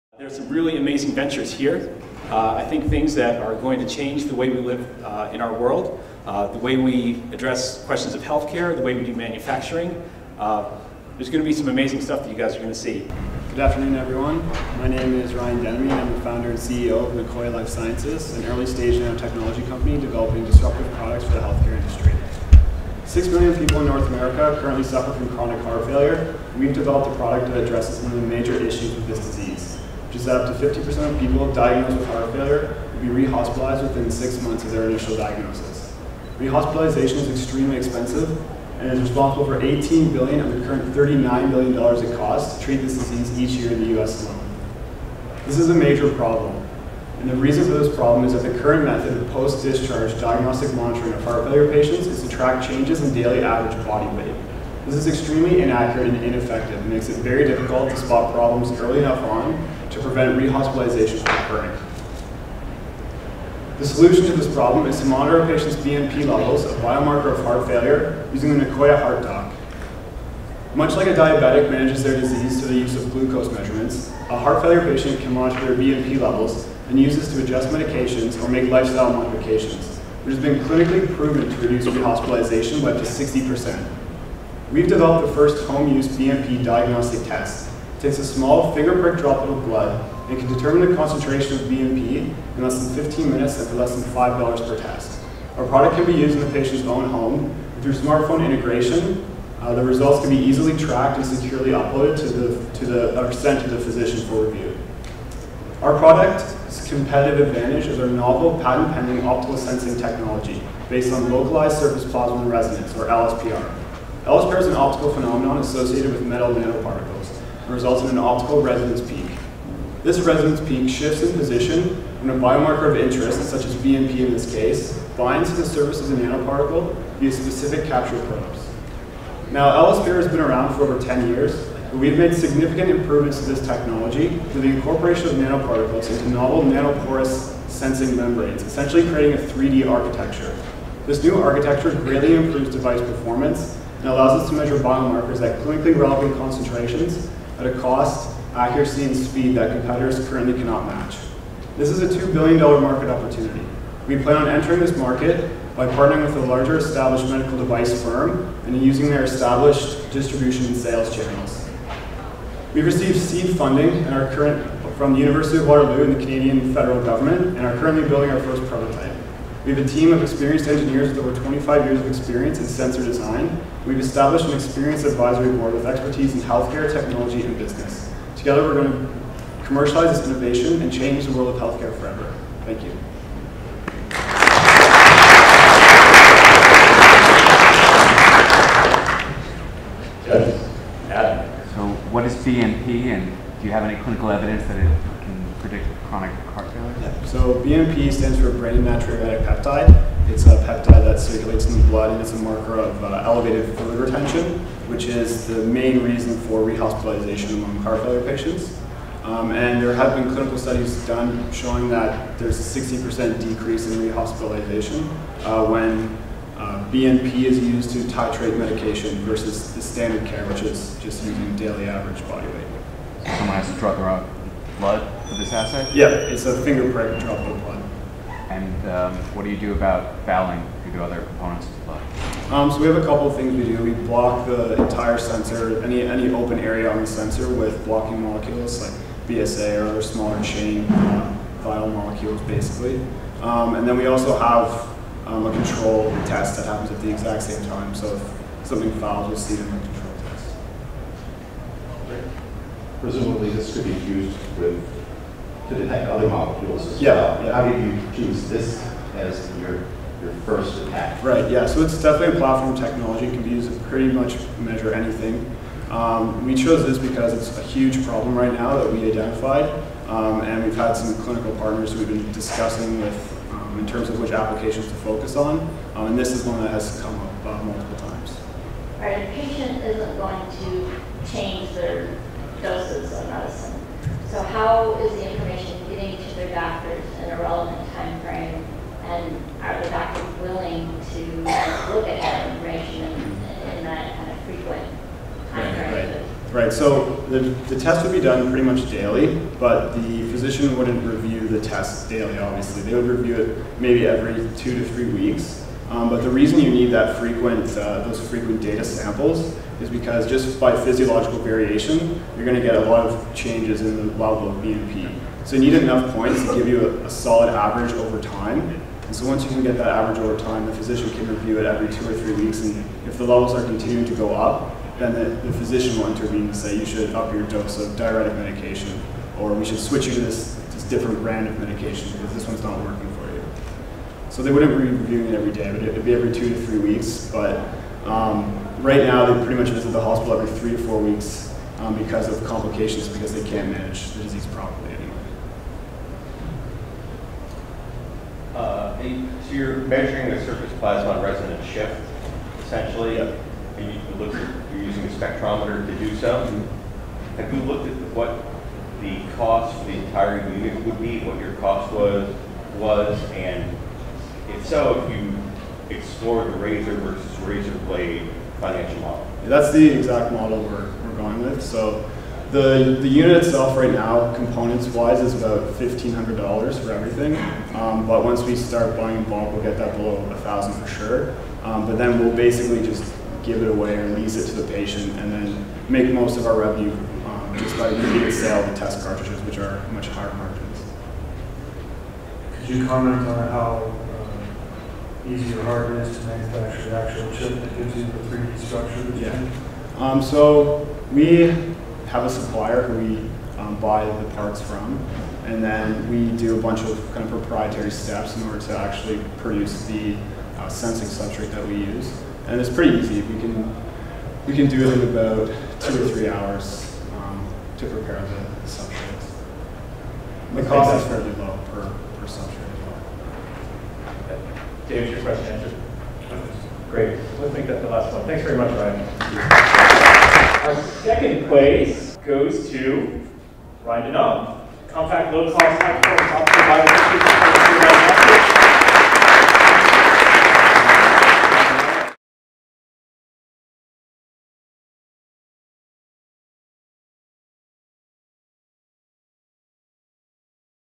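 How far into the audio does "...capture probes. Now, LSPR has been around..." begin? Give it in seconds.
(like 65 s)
127 s.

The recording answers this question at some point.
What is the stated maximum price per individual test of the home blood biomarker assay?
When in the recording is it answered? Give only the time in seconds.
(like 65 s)
94 s.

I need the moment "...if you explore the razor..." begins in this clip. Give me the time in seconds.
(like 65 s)
365 s.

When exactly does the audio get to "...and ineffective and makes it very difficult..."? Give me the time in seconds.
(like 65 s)
56 s.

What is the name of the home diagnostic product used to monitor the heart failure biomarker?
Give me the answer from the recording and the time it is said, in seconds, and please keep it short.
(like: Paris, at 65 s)
Nicoya Heart Doc, at 68 s.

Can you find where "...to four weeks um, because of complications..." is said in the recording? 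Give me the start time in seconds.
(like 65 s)
340 s.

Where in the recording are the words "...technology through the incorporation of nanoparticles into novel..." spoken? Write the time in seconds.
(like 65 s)
133 s.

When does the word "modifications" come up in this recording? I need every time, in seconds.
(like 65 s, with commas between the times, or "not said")
79 s.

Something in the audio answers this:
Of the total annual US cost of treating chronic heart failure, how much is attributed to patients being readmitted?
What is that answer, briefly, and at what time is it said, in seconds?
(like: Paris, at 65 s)
18 billion, at 39 s.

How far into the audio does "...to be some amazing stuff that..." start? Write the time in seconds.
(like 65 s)
11 s.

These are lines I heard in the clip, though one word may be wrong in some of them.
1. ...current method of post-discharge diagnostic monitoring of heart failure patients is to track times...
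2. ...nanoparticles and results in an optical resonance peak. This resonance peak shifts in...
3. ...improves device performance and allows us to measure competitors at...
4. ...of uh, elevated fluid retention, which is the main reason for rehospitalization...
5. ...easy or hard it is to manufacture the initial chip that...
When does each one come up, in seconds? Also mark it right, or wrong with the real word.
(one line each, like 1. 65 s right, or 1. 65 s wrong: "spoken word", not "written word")
1. 48 s wrong: "changes", not "times"
2. 116 s right
3. 142 s wrong: "biomarkers", not "competitors"
4. 202 s right
5. 395 s wrong: "actual", not "initial".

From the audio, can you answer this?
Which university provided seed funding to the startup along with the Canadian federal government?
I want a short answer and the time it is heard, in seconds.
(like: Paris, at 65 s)
University of Waterloo, at 165 s.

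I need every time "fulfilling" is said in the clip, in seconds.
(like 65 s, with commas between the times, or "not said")
not said.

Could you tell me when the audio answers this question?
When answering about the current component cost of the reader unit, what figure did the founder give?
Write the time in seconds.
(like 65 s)
375 s.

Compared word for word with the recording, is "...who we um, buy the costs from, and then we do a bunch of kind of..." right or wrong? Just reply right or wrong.
wrong.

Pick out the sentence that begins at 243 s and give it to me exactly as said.
Um, and then we also have um, a control test that happens at the exact same time.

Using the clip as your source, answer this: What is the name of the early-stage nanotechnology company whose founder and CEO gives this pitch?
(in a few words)
Nicoya Life Sciences.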